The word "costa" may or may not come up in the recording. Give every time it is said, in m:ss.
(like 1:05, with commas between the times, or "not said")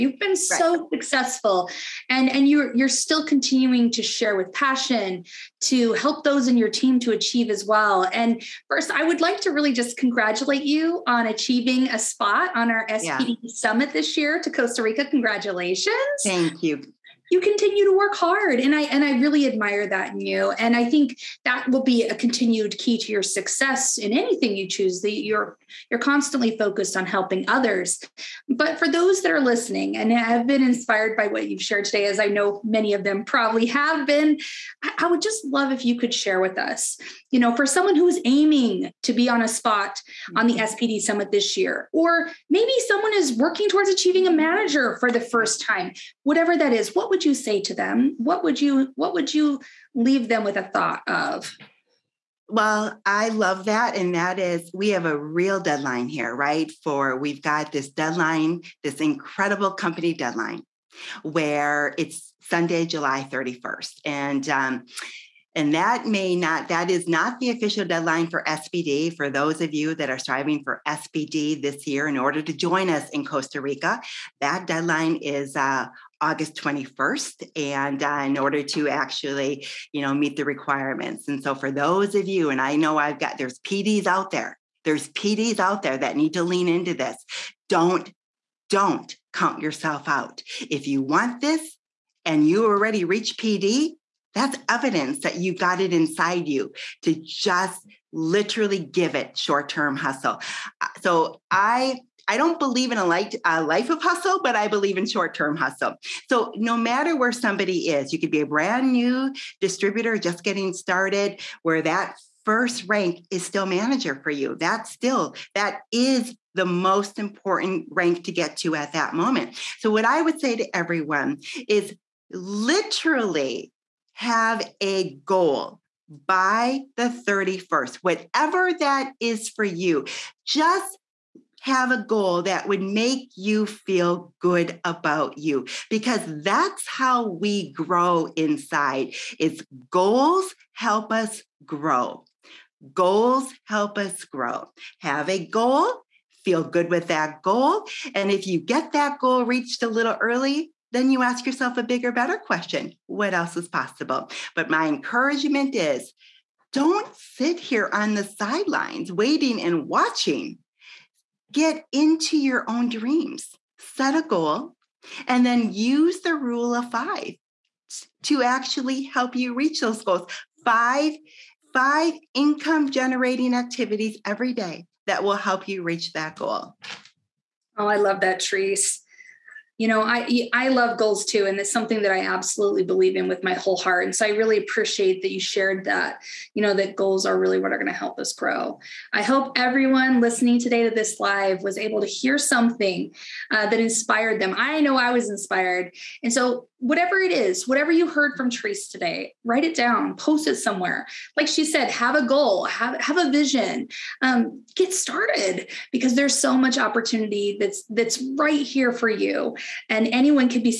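0:14, 1:13.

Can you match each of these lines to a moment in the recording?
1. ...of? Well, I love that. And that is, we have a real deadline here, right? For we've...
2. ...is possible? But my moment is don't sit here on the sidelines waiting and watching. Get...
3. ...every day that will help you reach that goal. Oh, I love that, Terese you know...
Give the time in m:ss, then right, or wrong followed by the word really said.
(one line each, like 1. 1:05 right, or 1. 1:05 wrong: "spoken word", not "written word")
1. 0:51 right
2. 2:33 wrong: "encouragement", not "moment"
3. 2:54 right.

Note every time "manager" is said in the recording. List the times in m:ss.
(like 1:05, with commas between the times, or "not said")
0:44, 1:53.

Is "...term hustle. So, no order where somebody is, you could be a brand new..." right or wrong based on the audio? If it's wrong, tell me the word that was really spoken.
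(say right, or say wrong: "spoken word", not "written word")
wrong: "matter", not "order".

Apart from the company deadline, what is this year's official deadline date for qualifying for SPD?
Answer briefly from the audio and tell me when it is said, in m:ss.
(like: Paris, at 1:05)
August 21st, at 1:16.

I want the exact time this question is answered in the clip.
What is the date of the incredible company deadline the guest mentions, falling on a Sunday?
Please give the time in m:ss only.
1:02.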